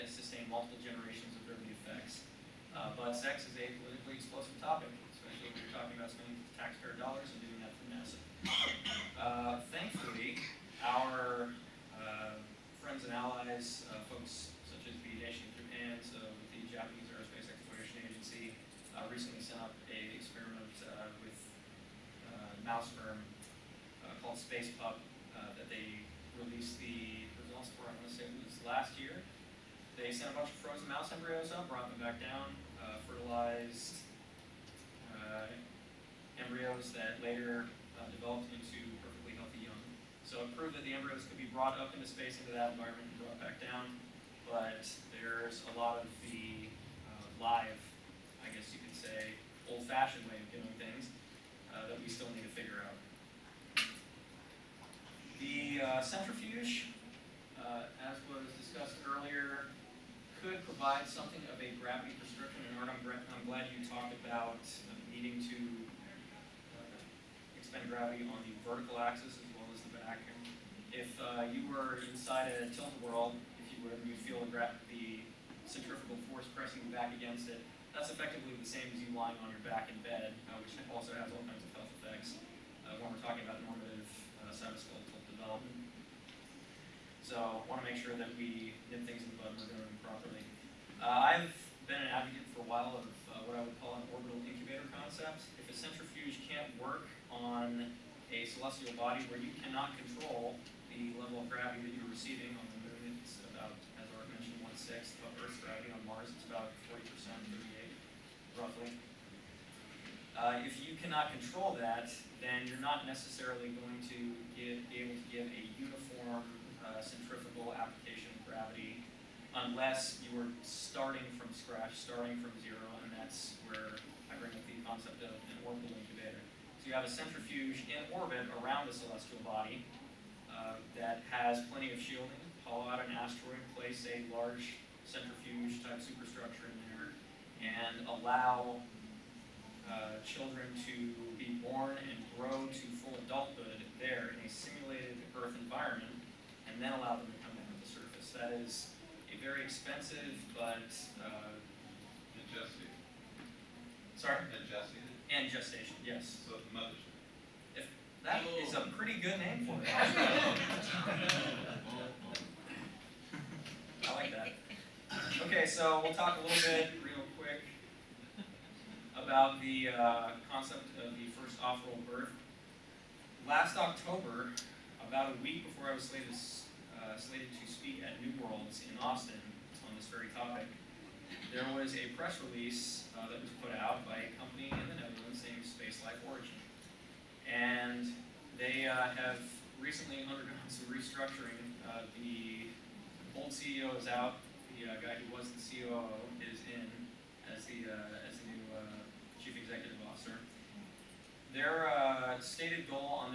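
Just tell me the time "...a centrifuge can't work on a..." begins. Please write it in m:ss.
1:35.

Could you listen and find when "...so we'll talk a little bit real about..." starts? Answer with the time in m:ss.
2:45.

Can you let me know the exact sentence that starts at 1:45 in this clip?
On Mars, it's about 40%, 38, roughly.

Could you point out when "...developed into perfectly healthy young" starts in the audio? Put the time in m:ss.
0:38.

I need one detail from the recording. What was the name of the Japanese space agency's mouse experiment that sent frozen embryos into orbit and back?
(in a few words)
Space Pup.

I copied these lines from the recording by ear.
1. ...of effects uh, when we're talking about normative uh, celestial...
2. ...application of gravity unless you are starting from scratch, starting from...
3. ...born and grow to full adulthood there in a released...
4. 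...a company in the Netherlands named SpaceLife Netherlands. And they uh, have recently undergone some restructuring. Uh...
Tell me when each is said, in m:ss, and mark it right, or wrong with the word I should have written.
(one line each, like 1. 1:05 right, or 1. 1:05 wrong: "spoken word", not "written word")
1. 1:21 wrong: "cytoskeletal", not "celestial"
2. 1:57 right
3. 2:21 wrong: "simulated", not "released"
4. 3:04 wrong: "Origin", not "Netherlands".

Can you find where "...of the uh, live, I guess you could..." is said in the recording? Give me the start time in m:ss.
0:46.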